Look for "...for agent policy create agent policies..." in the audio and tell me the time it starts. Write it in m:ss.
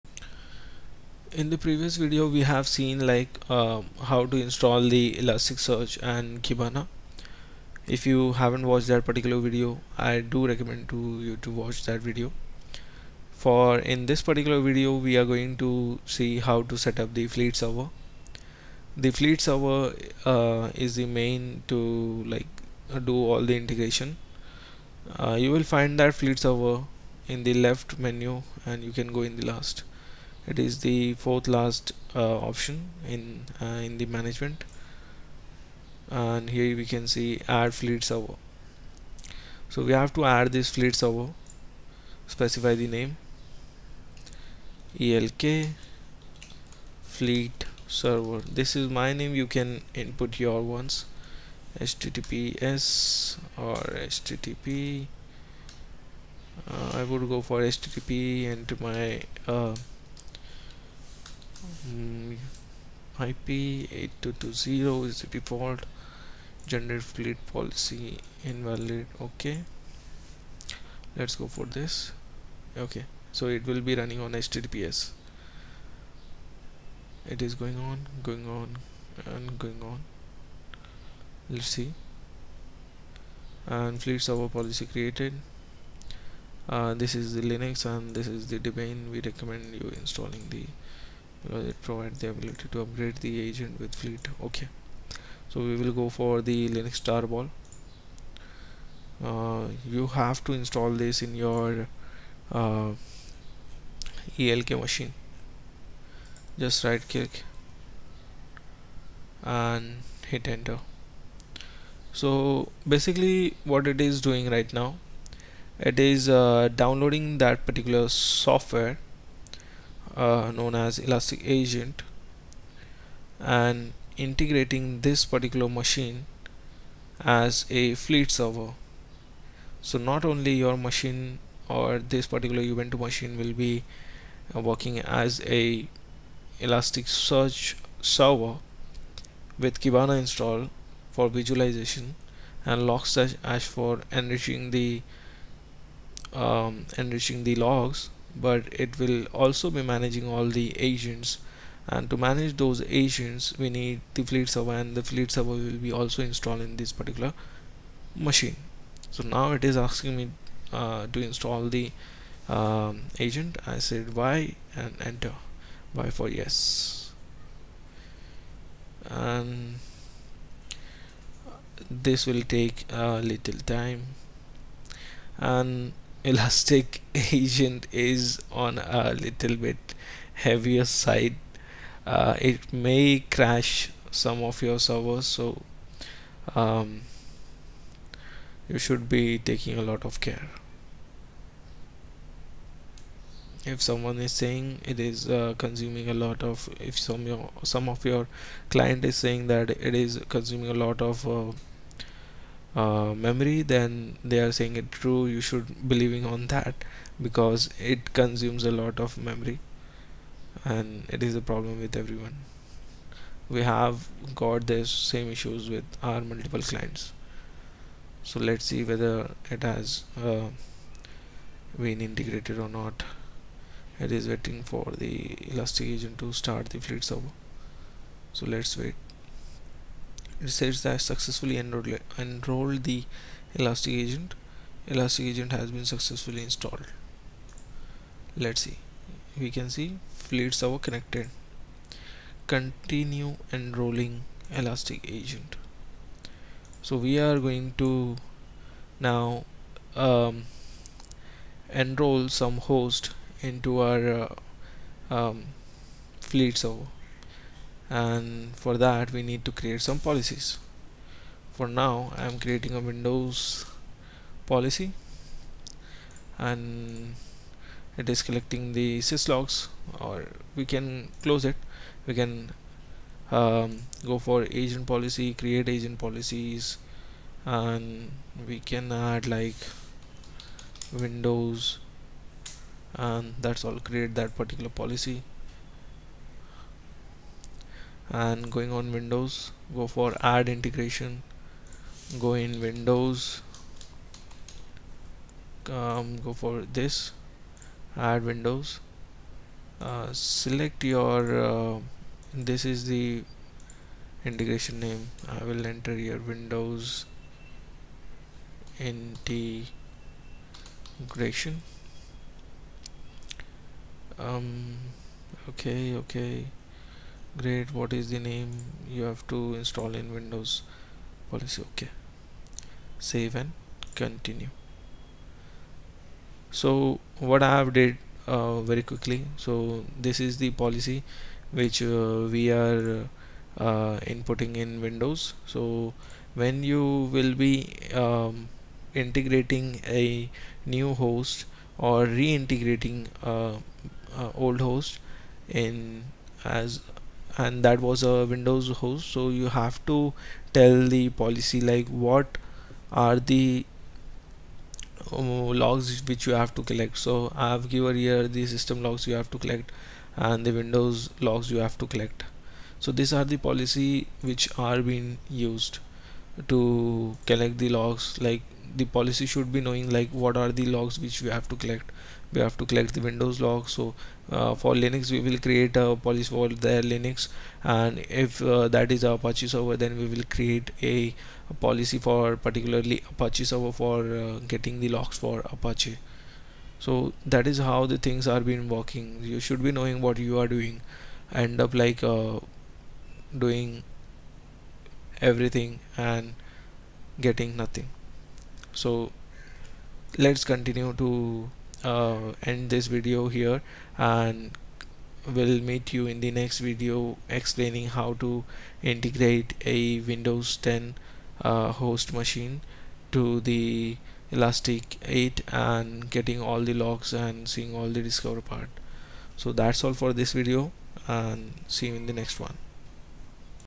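4:34.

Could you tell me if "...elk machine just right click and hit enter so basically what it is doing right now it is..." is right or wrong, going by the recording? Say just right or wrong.
right.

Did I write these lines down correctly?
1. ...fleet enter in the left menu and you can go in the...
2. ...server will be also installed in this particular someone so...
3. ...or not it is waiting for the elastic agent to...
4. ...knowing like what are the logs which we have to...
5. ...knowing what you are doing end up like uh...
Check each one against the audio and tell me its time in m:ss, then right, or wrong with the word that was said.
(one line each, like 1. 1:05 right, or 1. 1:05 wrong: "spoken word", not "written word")
1. 0:26 wrong: "server", not "enter"
2. 2:35 wrong: "machine", not "someone"
3. 3:42 right
4. 6:09 right
5. 6:29 right.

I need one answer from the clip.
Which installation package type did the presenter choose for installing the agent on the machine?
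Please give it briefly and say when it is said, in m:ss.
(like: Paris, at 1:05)
Linux tarball, at 1:36.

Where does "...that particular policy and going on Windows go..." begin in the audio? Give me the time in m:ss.
4:44.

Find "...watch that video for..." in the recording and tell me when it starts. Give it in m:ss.
0:11.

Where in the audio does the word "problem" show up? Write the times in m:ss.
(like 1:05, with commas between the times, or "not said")
3:31.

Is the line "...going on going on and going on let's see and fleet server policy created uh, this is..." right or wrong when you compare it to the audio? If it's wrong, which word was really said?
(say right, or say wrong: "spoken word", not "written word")
right.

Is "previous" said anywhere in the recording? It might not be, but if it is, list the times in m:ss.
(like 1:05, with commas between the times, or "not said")
0:01.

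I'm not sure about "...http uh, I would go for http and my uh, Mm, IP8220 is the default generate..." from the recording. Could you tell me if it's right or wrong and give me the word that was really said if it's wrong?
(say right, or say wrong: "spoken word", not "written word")
right.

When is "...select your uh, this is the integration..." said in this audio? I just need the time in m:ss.
5:00.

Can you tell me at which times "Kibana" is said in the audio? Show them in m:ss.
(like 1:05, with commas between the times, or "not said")
0:06, 2:19.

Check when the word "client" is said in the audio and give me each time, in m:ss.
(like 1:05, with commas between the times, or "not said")
3:18, 3:36.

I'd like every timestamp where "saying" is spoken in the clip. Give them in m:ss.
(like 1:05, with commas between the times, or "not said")
3:14, 3:19, 3:24.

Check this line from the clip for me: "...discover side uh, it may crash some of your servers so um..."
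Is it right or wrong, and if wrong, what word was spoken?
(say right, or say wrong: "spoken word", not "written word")
wrong: "heavier", not "discover".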